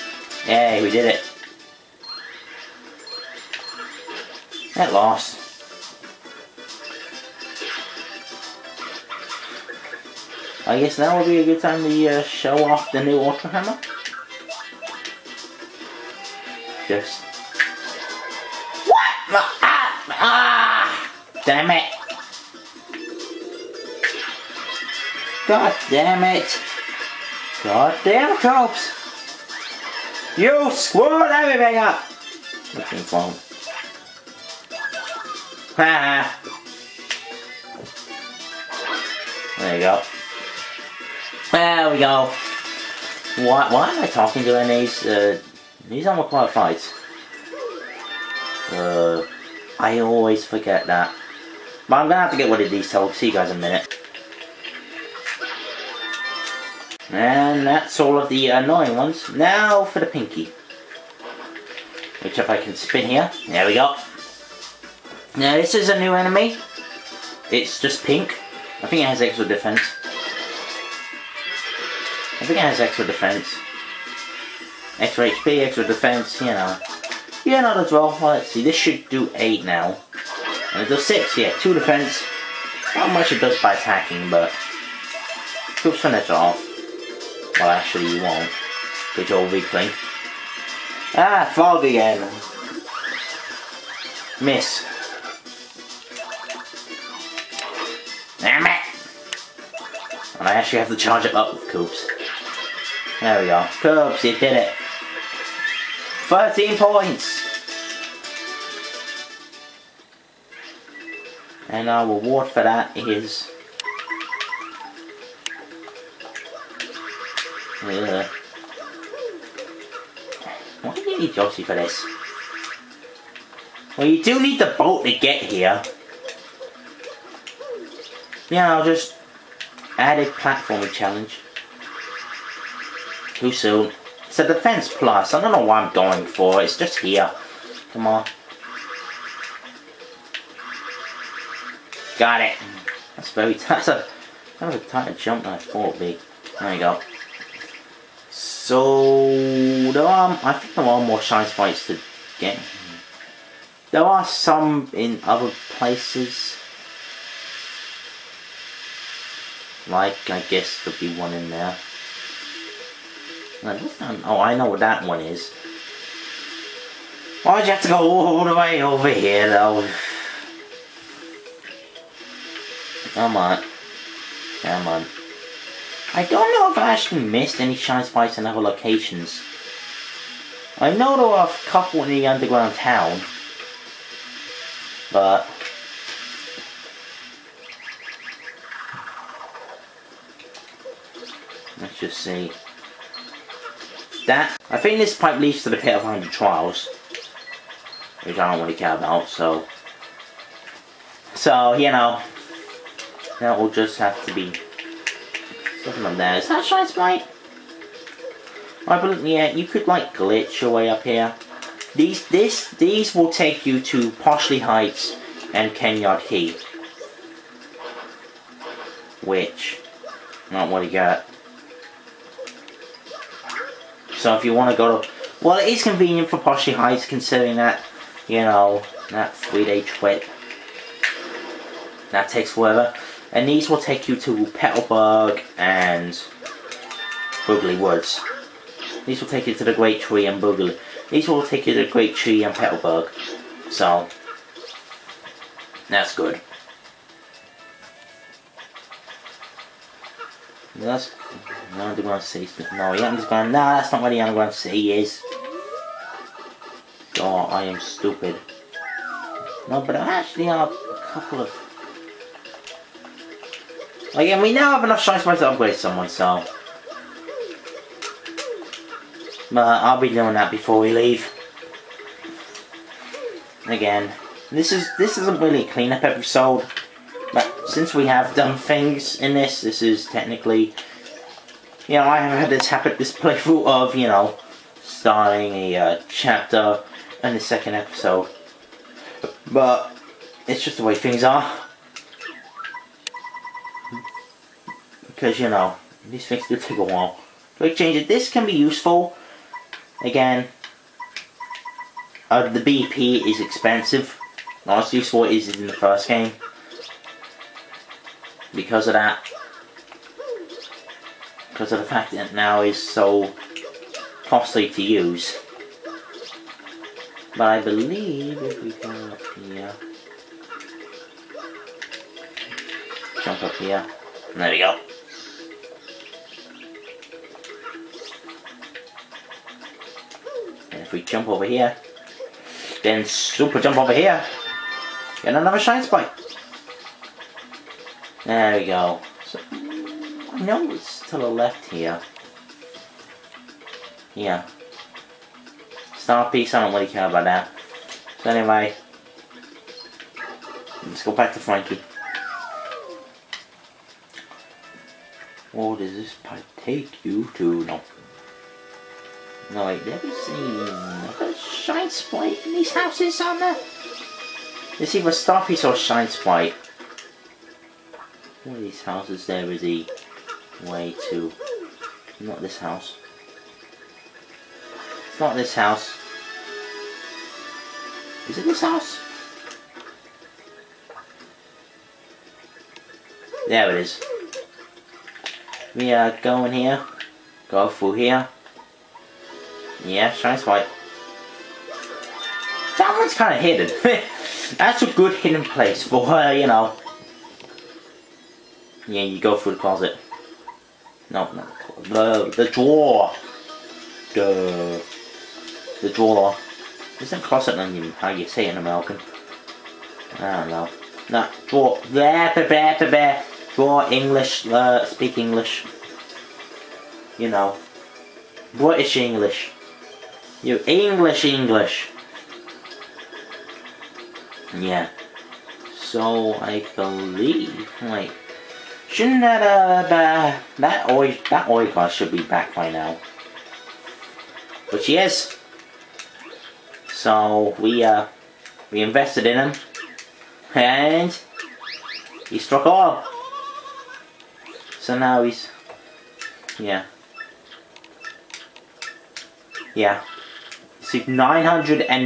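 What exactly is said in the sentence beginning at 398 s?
Yeah, you go through the closet.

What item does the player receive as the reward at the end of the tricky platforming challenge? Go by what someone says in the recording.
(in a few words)
Defense Plus.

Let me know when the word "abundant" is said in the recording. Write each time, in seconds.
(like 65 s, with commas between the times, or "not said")
not said.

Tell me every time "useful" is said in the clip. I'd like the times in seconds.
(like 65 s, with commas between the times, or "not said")
298 s, 304 s.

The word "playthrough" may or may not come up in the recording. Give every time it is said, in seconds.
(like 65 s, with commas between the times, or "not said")
283 s.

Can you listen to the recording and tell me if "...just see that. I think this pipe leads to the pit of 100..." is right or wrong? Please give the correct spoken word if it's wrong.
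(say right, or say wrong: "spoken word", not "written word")
right.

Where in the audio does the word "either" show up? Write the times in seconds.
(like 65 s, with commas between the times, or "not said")
364 s.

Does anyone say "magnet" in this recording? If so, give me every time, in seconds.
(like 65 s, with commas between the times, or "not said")
not said.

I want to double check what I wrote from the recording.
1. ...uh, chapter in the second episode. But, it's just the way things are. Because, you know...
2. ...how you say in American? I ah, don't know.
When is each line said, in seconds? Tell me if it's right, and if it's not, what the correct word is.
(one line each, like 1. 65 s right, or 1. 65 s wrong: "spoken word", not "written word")
1. 285 s right
2. 407 s right.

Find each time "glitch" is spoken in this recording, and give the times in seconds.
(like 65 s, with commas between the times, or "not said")
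210 s.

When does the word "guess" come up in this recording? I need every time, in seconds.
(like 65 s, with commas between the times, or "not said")
10 s, 160 s.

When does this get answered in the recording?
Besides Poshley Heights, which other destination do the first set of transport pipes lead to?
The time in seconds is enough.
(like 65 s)
215 s.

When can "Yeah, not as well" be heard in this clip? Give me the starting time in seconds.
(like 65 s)
77 s.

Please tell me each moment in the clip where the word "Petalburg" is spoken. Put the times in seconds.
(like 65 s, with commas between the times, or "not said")
234 s, 242 s.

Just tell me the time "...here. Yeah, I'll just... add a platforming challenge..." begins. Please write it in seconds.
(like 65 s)
125 s.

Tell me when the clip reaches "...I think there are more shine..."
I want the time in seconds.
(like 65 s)
150 s.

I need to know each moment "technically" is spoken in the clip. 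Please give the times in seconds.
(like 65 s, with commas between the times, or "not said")
280 s.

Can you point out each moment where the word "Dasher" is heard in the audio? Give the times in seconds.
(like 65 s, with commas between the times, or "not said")
not said.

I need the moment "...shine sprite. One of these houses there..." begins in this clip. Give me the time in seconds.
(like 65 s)
365 s.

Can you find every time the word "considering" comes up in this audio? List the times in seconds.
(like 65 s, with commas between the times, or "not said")
227 s.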